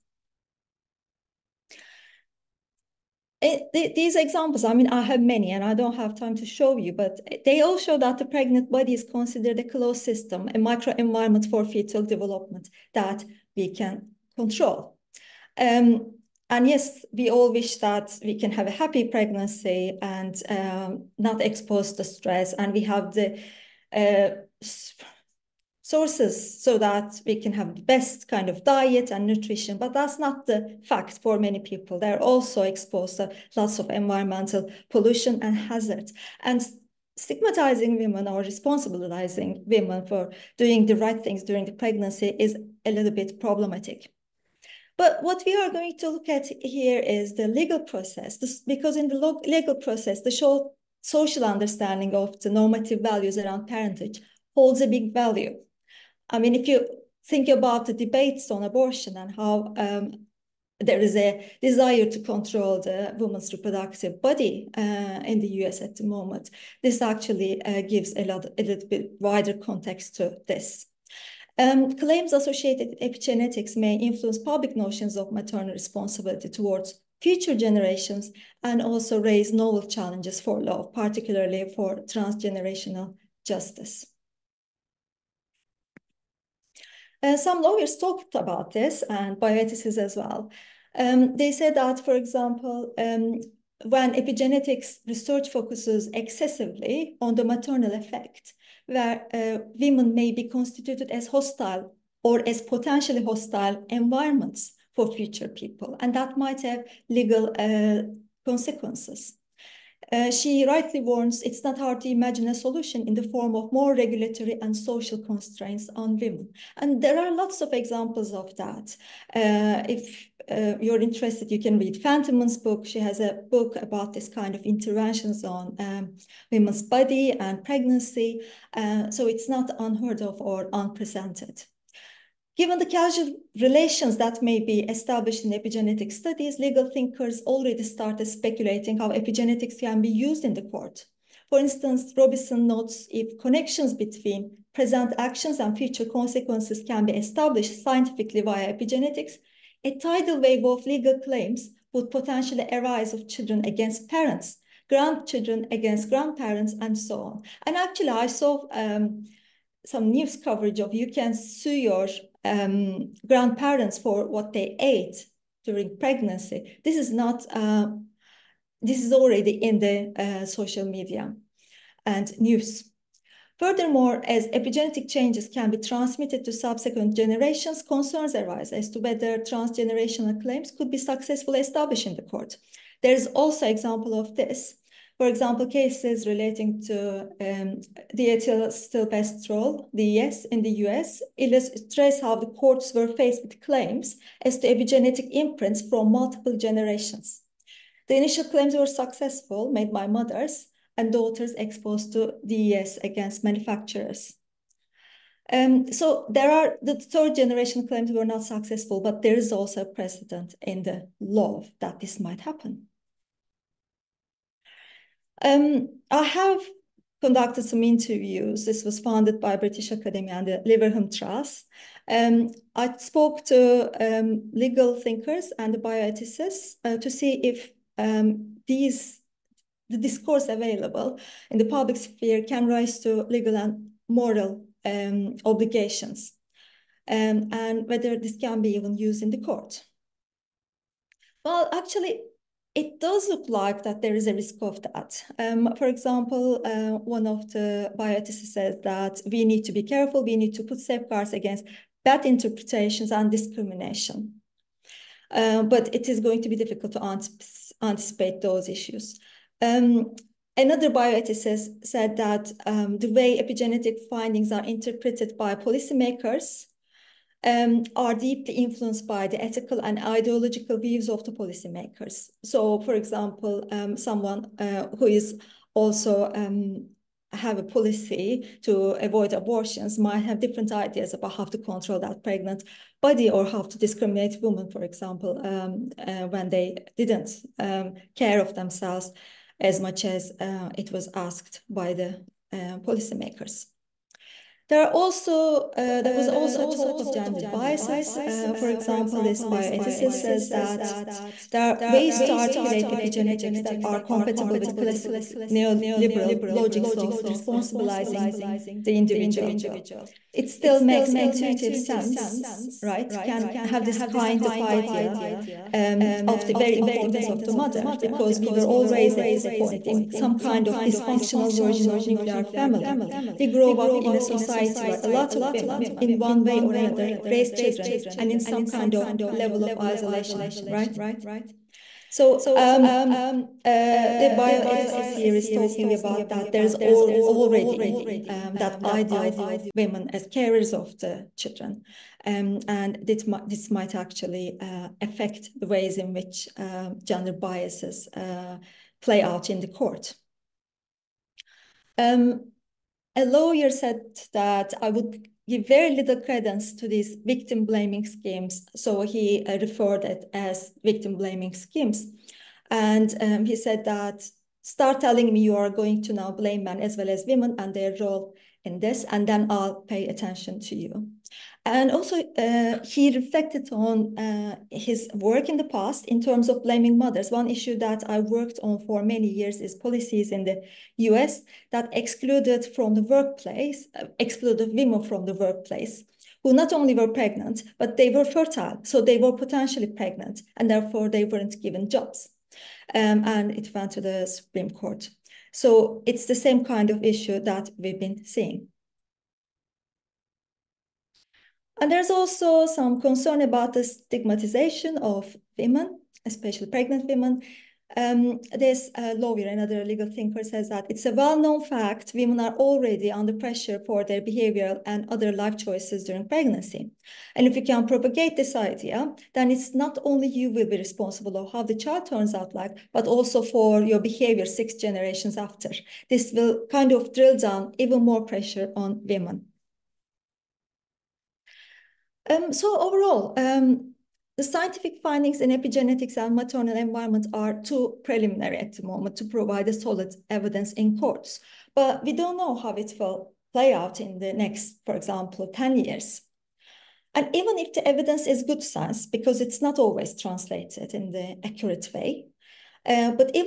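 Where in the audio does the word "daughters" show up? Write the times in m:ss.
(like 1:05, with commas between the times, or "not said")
3:21.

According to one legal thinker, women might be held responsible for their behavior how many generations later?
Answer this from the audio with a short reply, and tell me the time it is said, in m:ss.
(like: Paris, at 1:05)
6, at 7:04.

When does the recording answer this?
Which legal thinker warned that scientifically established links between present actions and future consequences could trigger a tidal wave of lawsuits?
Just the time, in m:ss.
2:22.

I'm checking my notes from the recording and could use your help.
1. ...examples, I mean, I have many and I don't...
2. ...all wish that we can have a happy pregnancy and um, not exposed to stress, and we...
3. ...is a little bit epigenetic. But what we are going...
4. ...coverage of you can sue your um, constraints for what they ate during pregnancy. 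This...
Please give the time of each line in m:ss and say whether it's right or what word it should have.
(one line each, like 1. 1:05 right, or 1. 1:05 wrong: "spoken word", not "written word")
1. 0:04 right
2. 0:17 right
3. 0:42 wrong: "problematic", not "epigenetic"
4. 2:40 wrong: "grandparents", not "constraints".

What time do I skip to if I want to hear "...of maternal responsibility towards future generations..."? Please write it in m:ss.
1:15.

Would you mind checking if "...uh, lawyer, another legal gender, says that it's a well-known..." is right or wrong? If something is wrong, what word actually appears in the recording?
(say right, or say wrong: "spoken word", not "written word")
wrong: "thinker", not "gender".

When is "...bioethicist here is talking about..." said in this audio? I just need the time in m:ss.
5:34.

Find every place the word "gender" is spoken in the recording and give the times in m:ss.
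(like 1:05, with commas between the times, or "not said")
4:57, 5:47.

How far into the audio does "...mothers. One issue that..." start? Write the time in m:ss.
6:16.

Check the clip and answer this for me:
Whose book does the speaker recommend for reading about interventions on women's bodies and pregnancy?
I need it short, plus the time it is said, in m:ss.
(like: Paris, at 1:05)
Phantom, at 2:02.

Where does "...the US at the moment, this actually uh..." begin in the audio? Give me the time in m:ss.
1:05.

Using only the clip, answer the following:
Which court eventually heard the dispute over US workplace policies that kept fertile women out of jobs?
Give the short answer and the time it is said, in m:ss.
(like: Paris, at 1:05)
The Supreme Court, at 6:34.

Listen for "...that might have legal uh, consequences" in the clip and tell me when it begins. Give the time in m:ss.
1:46.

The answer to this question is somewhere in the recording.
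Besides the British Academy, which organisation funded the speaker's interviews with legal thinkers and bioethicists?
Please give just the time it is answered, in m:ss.
3:40.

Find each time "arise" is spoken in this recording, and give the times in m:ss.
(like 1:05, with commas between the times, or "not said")
2:32, 2:58.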